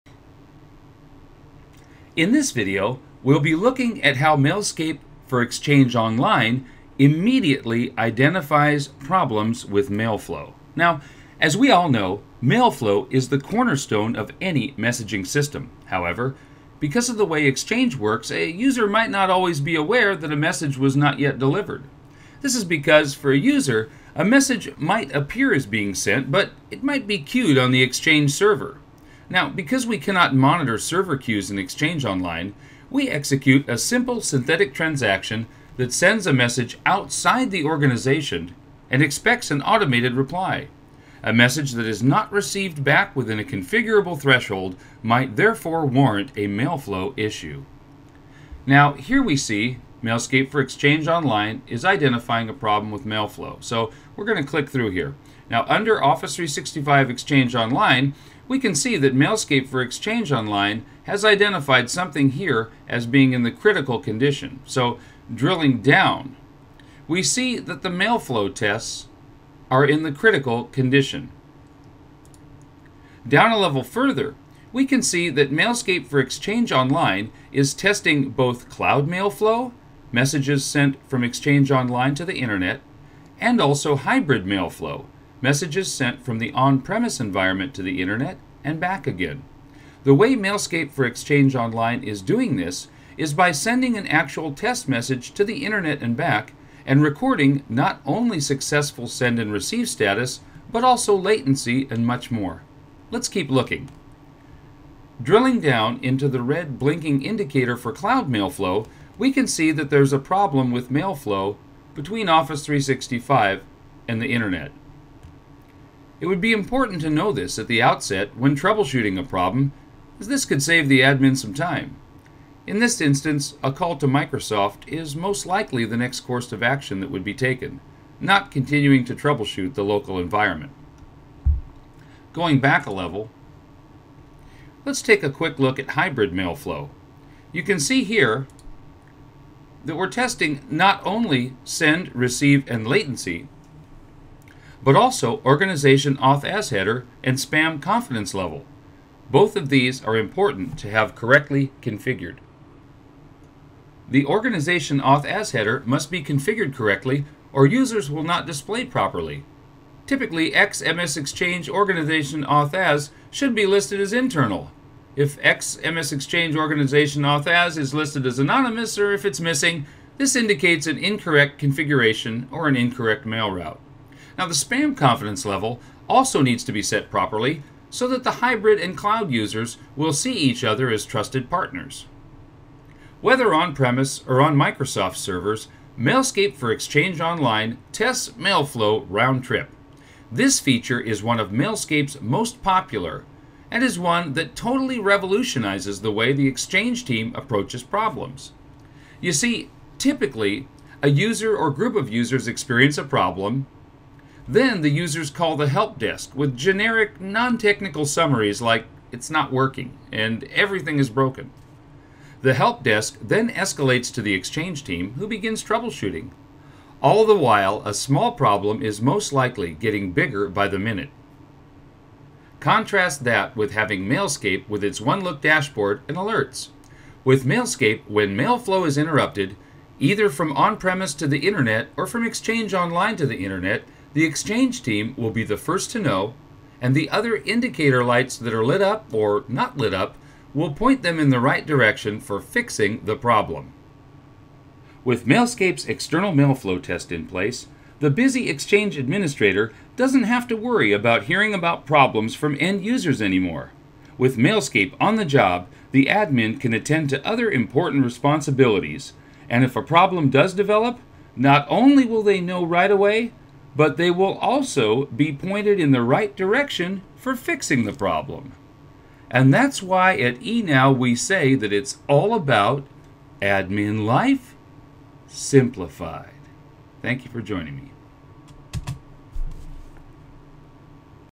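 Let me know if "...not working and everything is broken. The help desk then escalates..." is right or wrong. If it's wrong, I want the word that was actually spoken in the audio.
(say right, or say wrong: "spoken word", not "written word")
right.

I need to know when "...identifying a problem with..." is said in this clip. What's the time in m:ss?
0:51.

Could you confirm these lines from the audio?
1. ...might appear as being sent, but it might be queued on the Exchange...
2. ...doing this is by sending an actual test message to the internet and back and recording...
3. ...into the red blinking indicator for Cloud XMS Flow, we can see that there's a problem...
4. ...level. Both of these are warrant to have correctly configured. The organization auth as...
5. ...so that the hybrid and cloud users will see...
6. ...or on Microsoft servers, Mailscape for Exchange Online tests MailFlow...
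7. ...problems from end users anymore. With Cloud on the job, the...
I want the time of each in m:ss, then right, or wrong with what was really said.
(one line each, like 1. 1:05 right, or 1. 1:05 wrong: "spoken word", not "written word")
1. 0:24 right
2. 1:32 right
3. 1:46 wrong: "Mail", not "XMS"
4. 2:28 wrong: "important", not "warrant"
5. 2:57 right
6. 3:04 right
7. 4:11 wrong: "Mailscape", not "Cloud".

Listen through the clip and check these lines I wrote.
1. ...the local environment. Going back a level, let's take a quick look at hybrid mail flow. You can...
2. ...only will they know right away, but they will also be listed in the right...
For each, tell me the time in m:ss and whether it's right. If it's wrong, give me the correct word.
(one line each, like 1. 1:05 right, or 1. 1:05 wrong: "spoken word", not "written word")
1. 2:09 right
2. 4:21 wrong: "pointed", not "listed".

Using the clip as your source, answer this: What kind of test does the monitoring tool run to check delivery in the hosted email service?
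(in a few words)
Synthetic transaction.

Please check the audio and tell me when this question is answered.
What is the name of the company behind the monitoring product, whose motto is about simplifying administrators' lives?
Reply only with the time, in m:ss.
4:30.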